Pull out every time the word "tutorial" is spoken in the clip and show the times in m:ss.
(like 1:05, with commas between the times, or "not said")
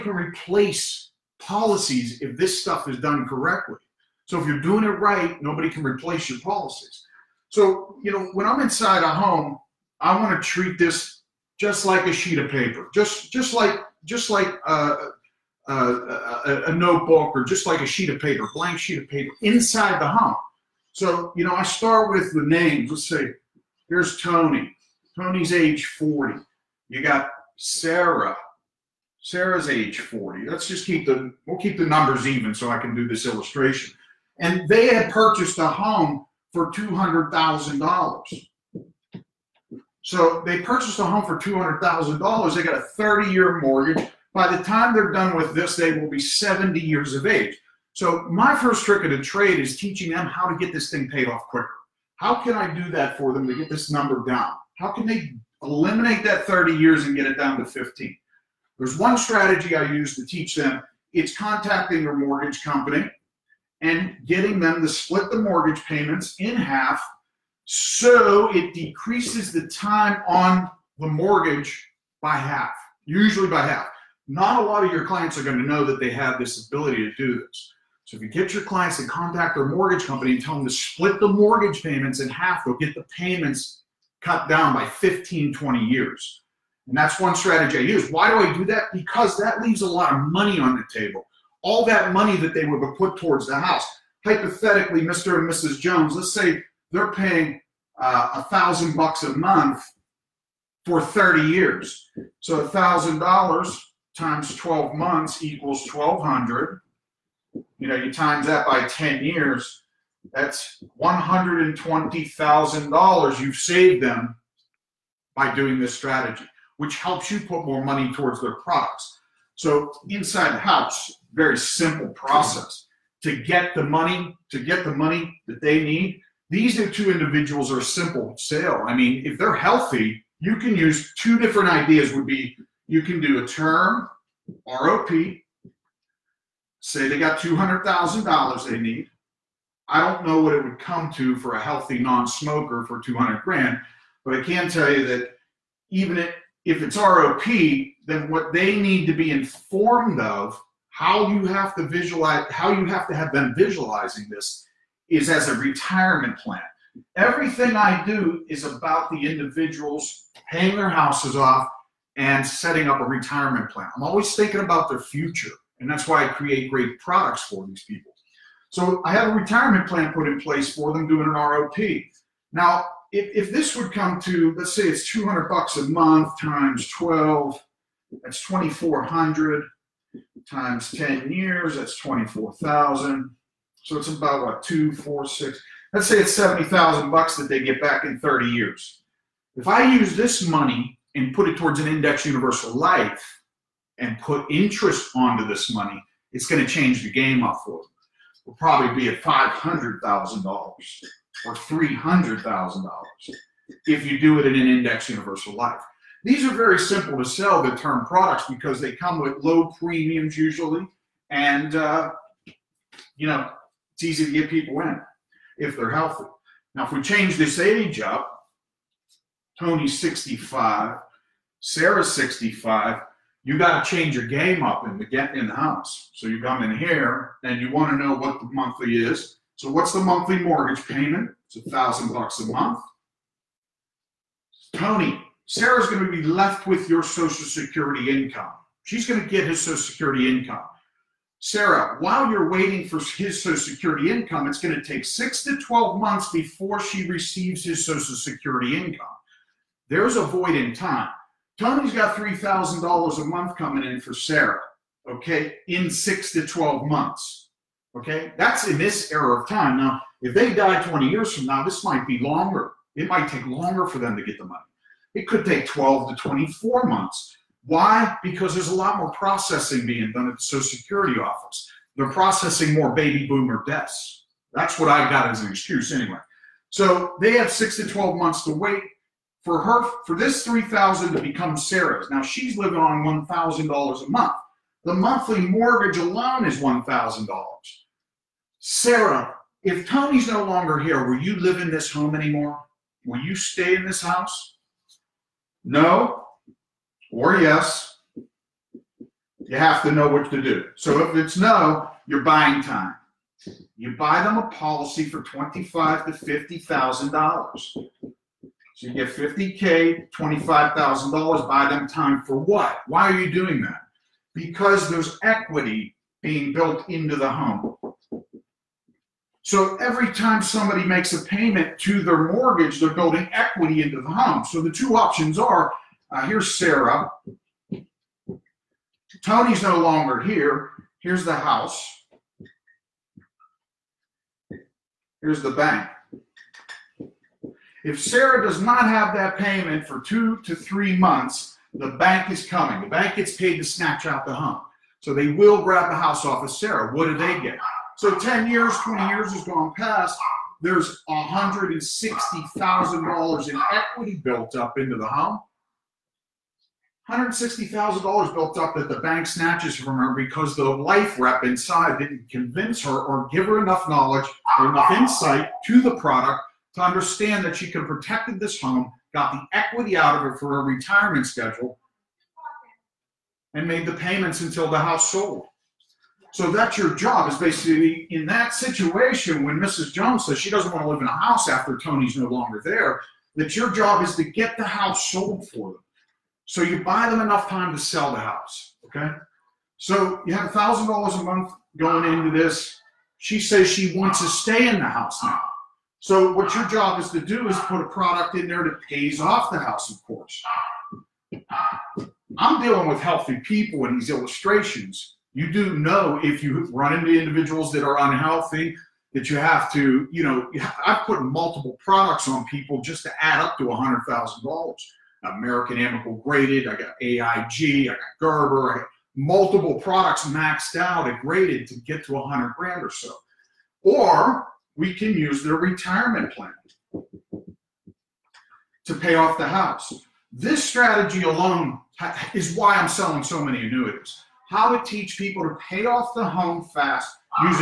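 not said.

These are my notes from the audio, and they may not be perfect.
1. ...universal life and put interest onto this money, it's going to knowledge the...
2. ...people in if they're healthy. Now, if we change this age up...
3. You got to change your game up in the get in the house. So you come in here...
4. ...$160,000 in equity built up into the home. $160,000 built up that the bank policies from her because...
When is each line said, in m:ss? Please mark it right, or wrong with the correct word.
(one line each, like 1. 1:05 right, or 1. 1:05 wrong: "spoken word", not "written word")
1. 3:12 wrong: "change", not "knowledge"
2. 3:34 right
3. 3:43 right
4. 5:51 wrong: "snatches", not "policies".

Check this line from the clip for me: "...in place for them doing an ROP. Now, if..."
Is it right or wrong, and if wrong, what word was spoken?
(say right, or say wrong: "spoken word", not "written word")
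right.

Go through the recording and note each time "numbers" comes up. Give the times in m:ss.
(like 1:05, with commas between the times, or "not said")
0:31, 0:53.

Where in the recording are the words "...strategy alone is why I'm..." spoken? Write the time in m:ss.
7:10.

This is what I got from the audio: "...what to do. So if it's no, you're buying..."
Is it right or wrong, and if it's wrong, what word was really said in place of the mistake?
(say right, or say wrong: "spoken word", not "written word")
right.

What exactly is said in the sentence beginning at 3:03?
So it's about what, two, four, six, let's say it's 70,000 bucks that they get back in 30 years.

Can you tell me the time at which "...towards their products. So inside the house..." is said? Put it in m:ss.
1:58.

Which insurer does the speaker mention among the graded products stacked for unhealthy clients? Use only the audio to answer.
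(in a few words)
American Amicable.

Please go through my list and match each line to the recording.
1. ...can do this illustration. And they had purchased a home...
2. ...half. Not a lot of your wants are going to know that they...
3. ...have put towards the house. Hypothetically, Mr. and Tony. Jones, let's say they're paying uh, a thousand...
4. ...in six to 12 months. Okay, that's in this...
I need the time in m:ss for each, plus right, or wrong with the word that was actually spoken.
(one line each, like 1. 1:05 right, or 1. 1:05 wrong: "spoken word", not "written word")
1. 0:32 right
2. 1:13 wrong: "clients", not "wants"
3. 1:32 wrong: "Mrs", not "Tony"
4. 4:15 right.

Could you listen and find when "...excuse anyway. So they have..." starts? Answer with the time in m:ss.
4:35.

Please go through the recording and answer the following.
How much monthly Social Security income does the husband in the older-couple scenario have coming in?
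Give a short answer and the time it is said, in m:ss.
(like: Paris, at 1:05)
$3,000, at 4:12.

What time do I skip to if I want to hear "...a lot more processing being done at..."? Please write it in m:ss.
4:28.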